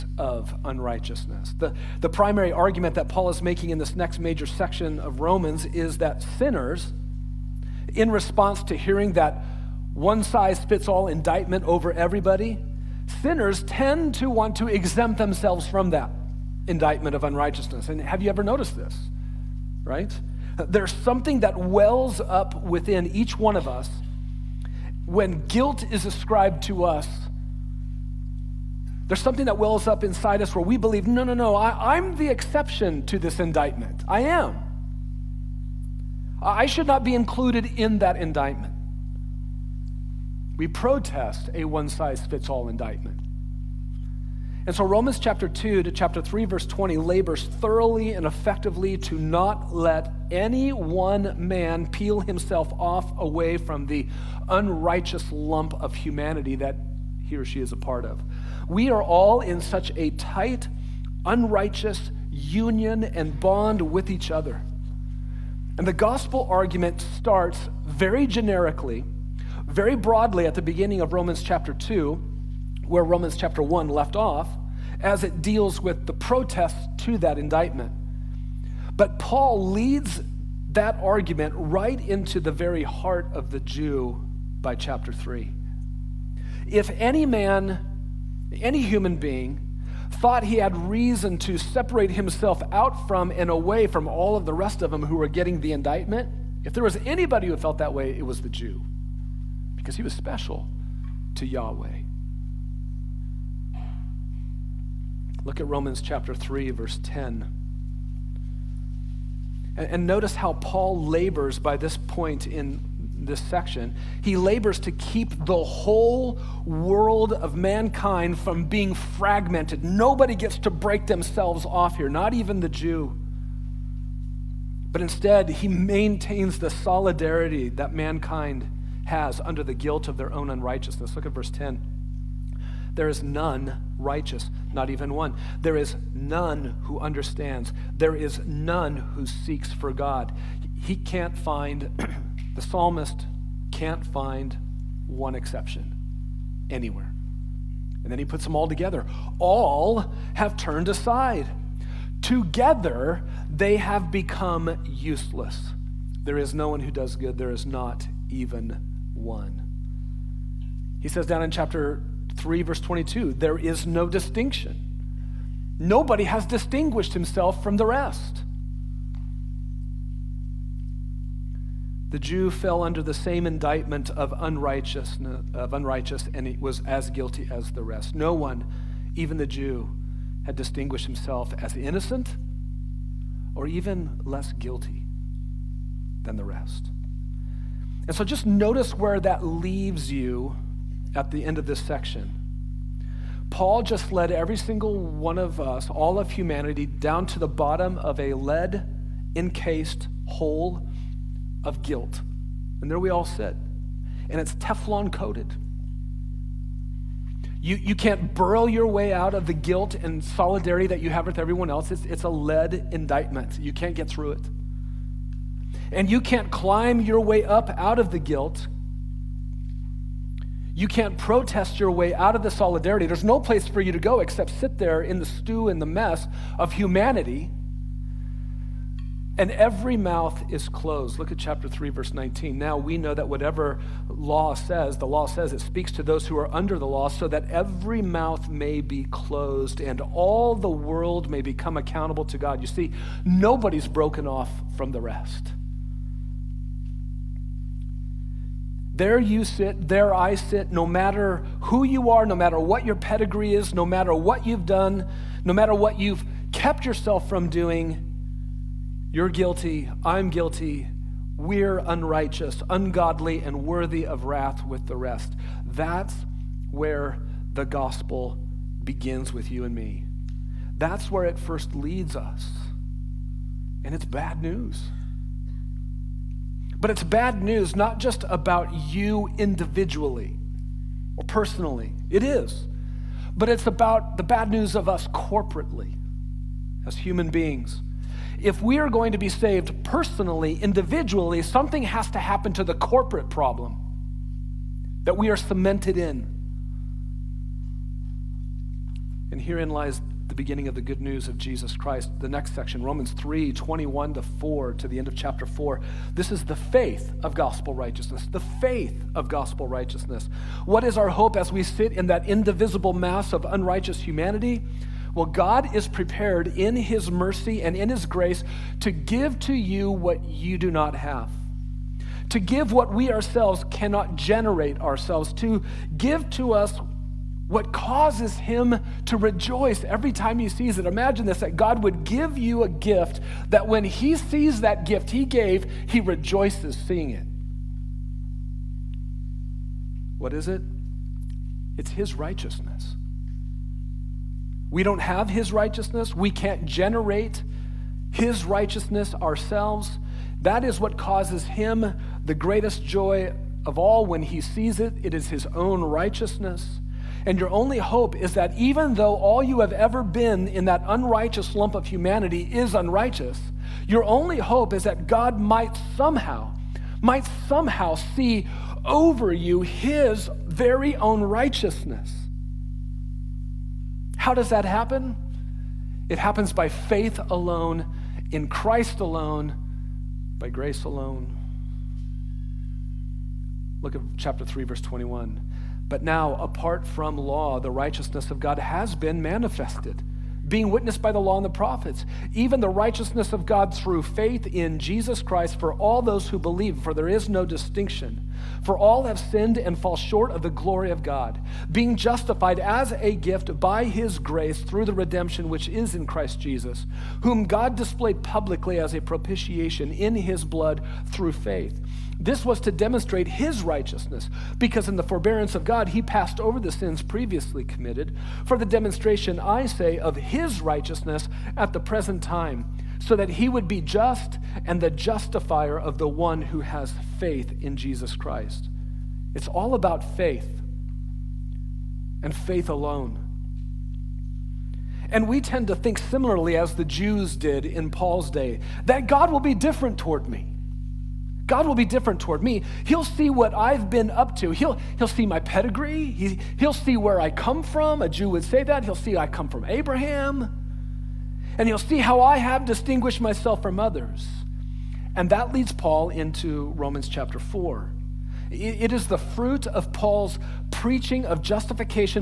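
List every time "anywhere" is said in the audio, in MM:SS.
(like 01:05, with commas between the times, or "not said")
02:26.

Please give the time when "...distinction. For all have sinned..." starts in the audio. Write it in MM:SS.
06:37.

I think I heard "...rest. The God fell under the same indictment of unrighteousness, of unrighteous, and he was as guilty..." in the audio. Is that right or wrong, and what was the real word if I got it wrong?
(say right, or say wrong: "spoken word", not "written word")
wrong: "Jew", not "God".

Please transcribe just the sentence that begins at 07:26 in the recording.
He, he'll see where I come from.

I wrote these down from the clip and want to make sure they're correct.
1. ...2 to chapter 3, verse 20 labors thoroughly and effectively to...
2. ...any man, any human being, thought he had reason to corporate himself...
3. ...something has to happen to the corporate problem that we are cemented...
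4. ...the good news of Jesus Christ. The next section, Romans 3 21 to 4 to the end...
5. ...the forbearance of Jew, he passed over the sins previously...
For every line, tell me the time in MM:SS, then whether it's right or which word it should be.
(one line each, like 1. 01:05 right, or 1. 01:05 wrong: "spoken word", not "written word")
1. 00:45 right
2. 01:26 wrong: "separate", not "corporate"
3. 04:51 right
4. 05:00 right
5. 06:54 wrong: "God", not "Jew".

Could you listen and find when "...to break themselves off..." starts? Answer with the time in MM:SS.
02:00.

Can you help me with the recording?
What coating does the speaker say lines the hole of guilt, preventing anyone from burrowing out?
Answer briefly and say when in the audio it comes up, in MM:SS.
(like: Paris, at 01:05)
Teflon, at 03:24.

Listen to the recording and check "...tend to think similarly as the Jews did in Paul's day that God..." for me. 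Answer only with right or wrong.
right.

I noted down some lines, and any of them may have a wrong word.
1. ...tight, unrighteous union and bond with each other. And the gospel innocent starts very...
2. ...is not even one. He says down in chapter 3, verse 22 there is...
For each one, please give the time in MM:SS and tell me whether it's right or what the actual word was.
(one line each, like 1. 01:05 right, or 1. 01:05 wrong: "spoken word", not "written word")
1. 01:00 wrong: "argument", not "innocent"
2. 02:37 right.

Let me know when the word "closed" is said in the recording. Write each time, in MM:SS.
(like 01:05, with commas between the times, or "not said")
03:50, 03:59.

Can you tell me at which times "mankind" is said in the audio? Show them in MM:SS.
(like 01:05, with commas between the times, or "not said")
01:57, 02:07.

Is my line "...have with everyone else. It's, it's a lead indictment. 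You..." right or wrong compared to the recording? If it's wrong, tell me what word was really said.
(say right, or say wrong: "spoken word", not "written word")
right.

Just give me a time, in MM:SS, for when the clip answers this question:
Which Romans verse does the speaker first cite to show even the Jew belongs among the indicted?
01:45.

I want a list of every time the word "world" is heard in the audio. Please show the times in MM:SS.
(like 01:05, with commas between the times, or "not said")
01:56, 04:00.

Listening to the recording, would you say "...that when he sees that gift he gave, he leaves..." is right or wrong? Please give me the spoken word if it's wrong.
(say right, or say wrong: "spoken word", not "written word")
wrong: "rejoices", not "leaves".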